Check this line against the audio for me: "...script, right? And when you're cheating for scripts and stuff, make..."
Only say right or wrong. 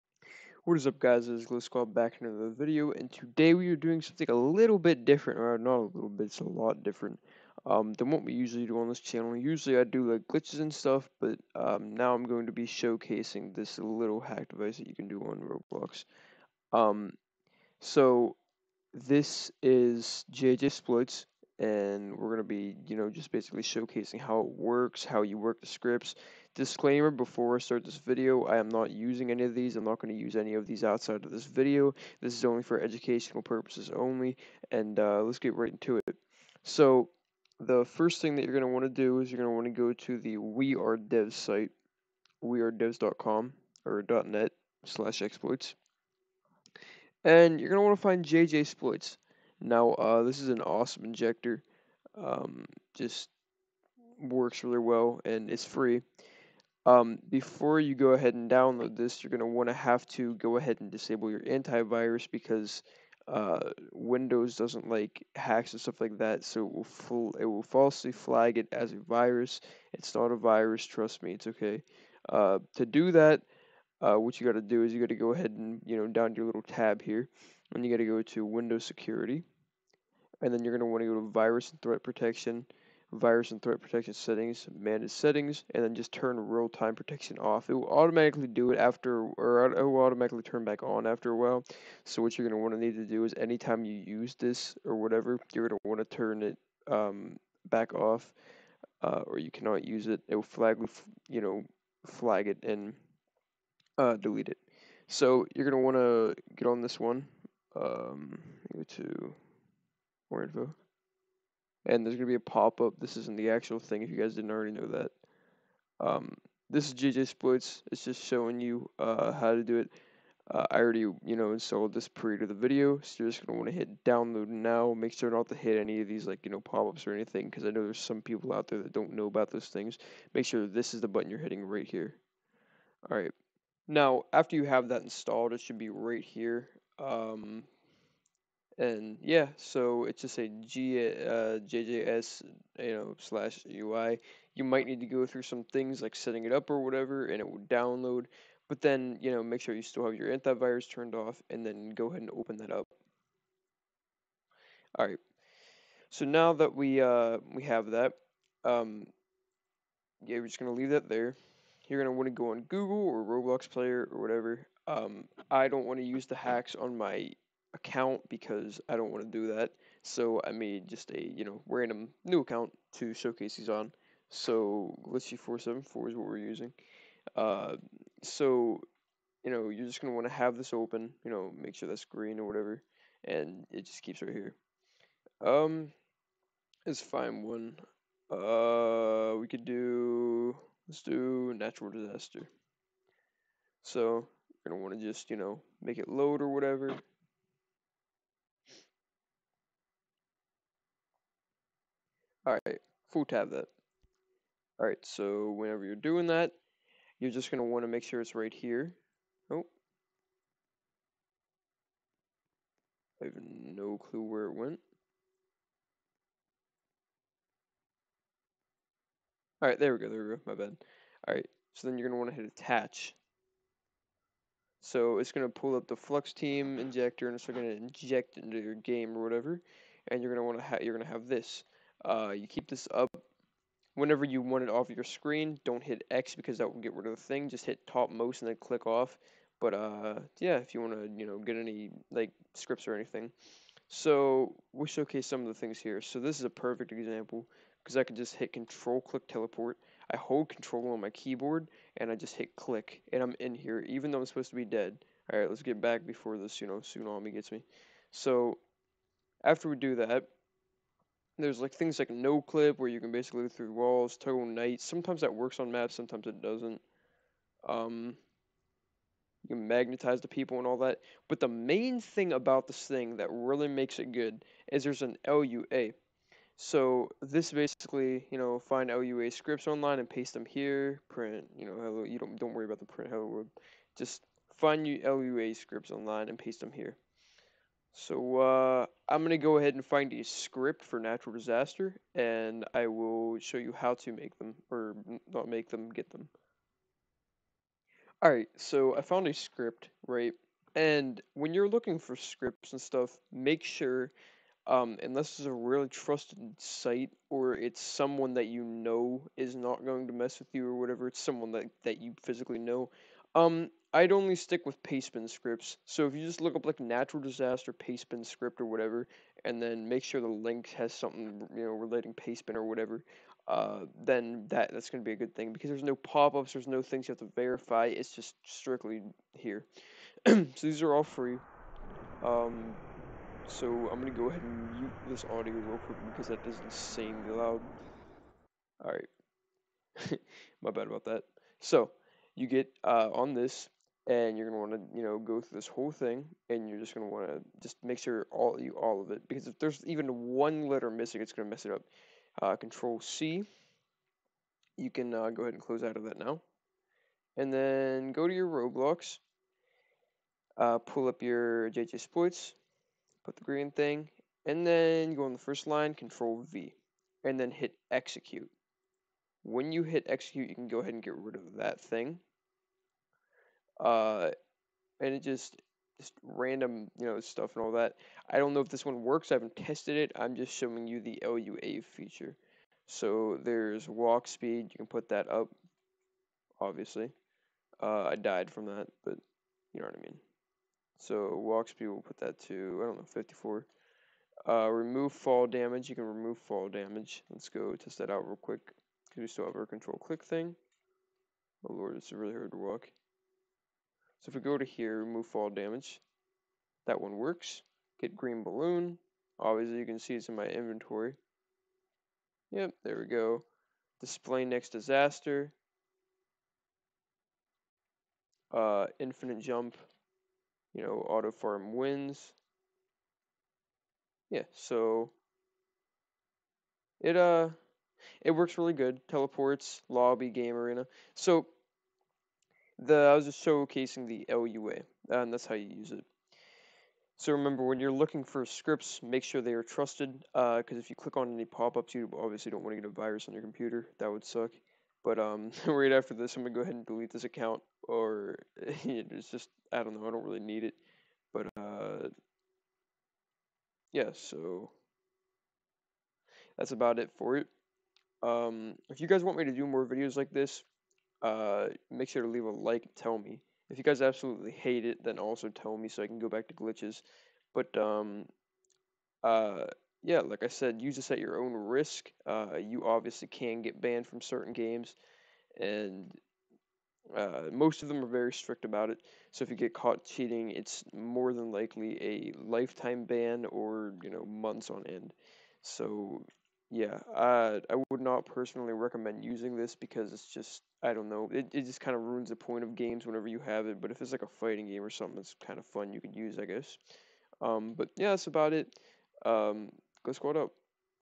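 wrong.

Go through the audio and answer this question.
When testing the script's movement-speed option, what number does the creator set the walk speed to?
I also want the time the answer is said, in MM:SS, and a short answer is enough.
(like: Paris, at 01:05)
54, at 06:33.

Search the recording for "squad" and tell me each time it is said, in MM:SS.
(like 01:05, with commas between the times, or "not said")
00:01, 08:20.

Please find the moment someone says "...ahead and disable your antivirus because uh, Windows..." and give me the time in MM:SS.
01:00.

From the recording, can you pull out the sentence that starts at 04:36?
So this basically, you know, find LUA scripts online and paste them here.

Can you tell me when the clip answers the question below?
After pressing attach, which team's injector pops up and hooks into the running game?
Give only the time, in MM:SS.
03:45.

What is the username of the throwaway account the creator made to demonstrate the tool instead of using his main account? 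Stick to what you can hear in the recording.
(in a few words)
Glitchy 474.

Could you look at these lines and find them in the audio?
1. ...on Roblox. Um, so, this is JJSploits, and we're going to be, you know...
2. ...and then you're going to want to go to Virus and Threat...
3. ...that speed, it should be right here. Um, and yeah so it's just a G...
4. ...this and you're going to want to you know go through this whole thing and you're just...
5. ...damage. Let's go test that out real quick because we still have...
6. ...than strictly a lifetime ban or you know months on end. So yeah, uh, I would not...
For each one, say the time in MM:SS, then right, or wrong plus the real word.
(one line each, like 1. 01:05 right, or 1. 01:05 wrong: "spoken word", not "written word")
1. 00:15 right
2. 01:20 right
3. 02:14 wrong: "installed", not "speed"
4. 05:43 right
5. 06:36 right
6. 08:01 wrong: "likely", not "strictly".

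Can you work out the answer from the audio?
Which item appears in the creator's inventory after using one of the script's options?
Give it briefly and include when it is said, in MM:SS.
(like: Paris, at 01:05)
green balloon, at 06:48.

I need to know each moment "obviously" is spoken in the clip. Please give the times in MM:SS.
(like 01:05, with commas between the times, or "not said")
06:26, 06:49, 07:22, 07:52.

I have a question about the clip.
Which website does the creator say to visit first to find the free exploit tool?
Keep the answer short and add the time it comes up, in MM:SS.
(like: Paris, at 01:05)
We Are Devs, at 00:40.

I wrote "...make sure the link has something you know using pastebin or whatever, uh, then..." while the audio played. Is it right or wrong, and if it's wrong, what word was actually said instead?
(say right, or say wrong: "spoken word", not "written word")
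wrong: "relating", not "using".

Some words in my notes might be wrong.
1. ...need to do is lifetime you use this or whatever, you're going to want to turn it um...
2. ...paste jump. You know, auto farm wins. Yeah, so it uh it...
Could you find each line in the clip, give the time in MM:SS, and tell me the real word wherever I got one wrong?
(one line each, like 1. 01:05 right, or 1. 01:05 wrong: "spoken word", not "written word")
1. 01:32 wrong: "anytime", not "lifetime"
2. 06:58 wrong: "infinite", not "paste".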